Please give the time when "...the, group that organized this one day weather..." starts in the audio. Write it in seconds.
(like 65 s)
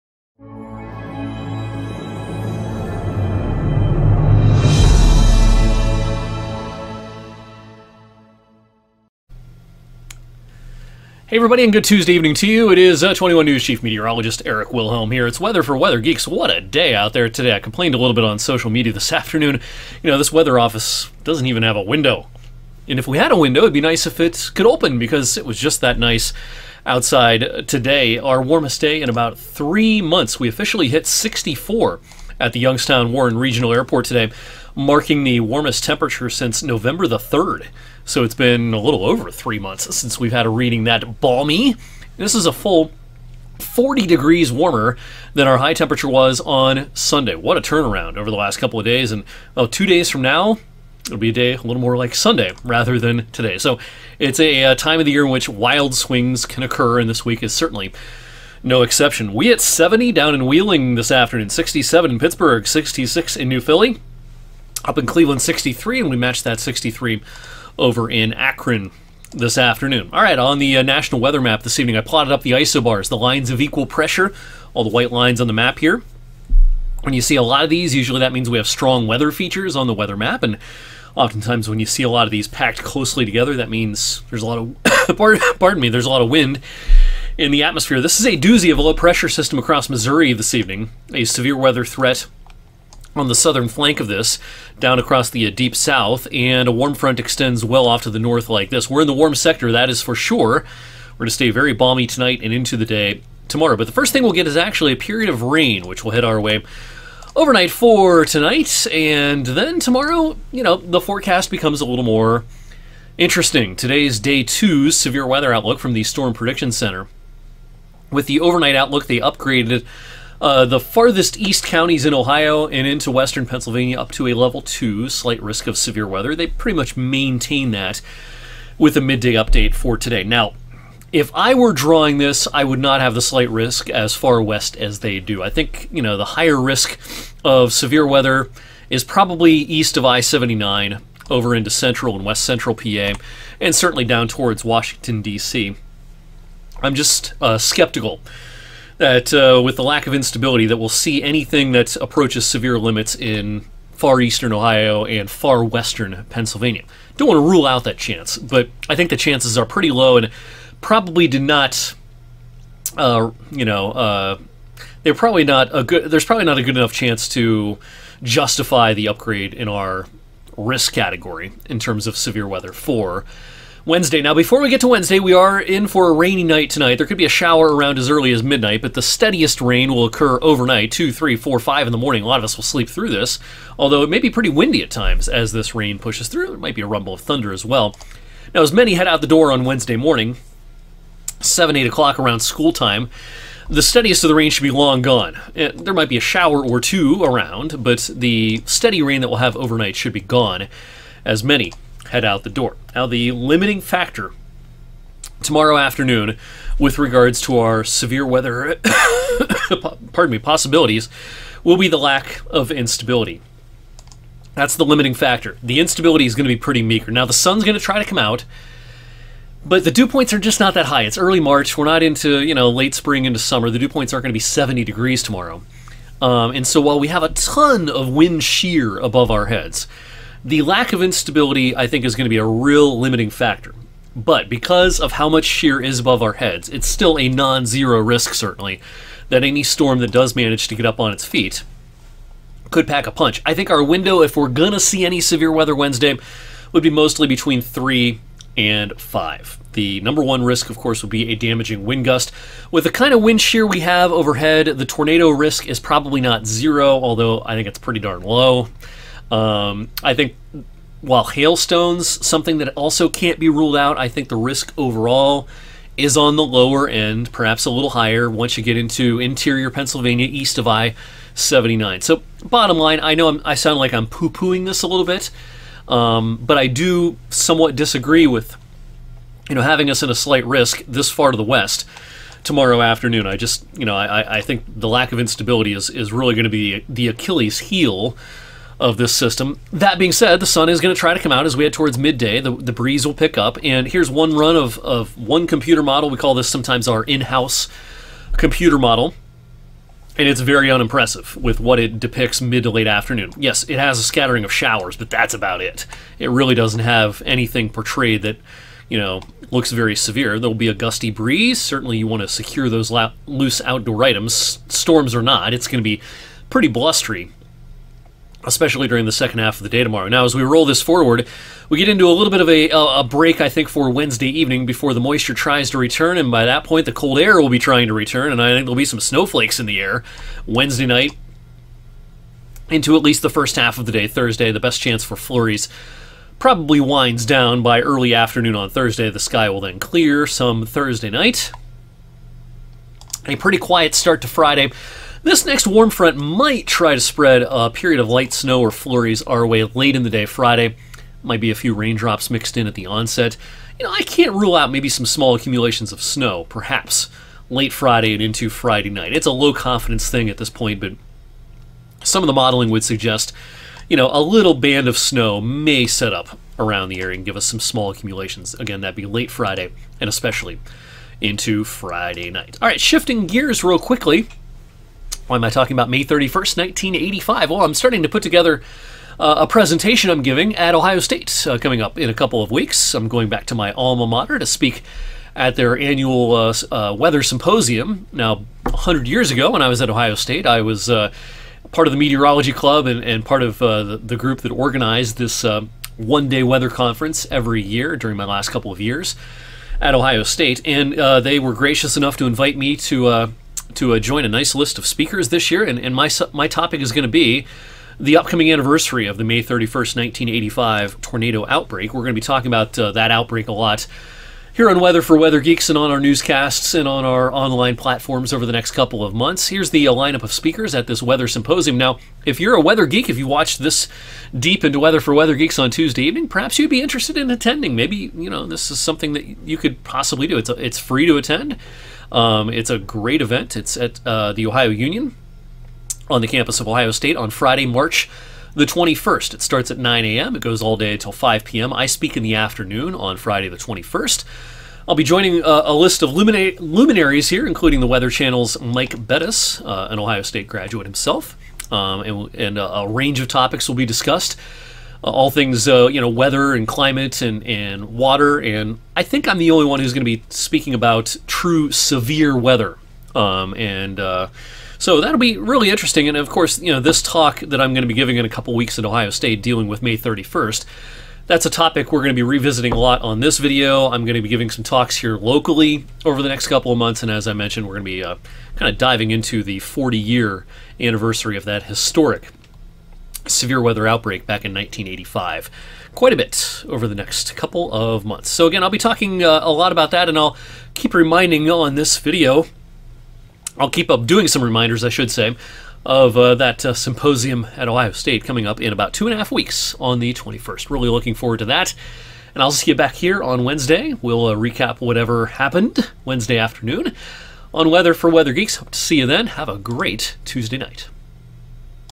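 393 s.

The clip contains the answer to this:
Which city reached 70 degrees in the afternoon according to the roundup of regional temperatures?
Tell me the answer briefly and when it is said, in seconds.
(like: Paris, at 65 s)
Wheeling, at 60 s.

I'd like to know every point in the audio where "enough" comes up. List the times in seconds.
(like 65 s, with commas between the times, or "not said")
166 s, 401 s.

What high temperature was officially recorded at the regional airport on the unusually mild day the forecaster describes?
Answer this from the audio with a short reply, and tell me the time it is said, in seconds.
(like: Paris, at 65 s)
64, at 31 s.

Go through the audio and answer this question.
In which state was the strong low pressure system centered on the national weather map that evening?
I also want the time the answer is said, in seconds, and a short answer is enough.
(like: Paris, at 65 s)
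Missouri, at 89 s.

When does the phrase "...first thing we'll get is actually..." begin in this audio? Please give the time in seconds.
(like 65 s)
103 s.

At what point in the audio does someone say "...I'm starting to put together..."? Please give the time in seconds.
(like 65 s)
377 s.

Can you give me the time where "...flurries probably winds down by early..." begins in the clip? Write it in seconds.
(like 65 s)
335 s.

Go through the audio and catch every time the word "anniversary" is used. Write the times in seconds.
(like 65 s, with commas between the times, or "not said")
408 s, 480 s.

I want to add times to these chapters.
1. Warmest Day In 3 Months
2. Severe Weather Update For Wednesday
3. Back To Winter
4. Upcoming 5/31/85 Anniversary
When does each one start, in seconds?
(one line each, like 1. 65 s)
1. 25 s
2. 110 s
3. 295 s
4. 375 s.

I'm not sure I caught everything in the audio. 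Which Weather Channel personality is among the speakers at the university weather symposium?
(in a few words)
Mike Bettes.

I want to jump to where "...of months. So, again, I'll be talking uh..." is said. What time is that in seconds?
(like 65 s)
487 s.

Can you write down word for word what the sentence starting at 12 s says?
It is uh, 21 News Chief Meteorologist Eric Wilhelm here.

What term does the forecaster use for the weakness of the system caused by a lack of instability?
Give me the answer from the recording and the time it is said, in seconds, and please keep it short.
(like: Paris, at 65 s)
Achilles heel, at 287 s.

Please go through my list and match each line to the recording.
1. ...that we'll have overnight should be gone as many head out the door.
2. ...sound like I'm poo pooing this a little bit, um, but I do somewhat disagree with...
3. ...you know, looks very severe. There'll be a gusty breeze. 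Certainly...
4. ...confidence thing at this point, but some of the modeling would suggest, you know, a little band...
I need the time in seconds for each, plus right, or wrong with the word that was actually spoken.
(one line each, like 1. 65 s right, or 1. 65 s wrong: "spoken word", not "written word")
1. 199 s right
2. 273 s right
3. 308 s right
4. 359 s right.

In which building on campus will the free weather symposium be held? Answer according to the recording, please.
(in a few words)
Ohio Union.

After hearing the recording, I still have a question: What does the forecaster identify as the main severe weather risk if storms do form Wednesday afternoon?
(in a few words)
damaging wind gust.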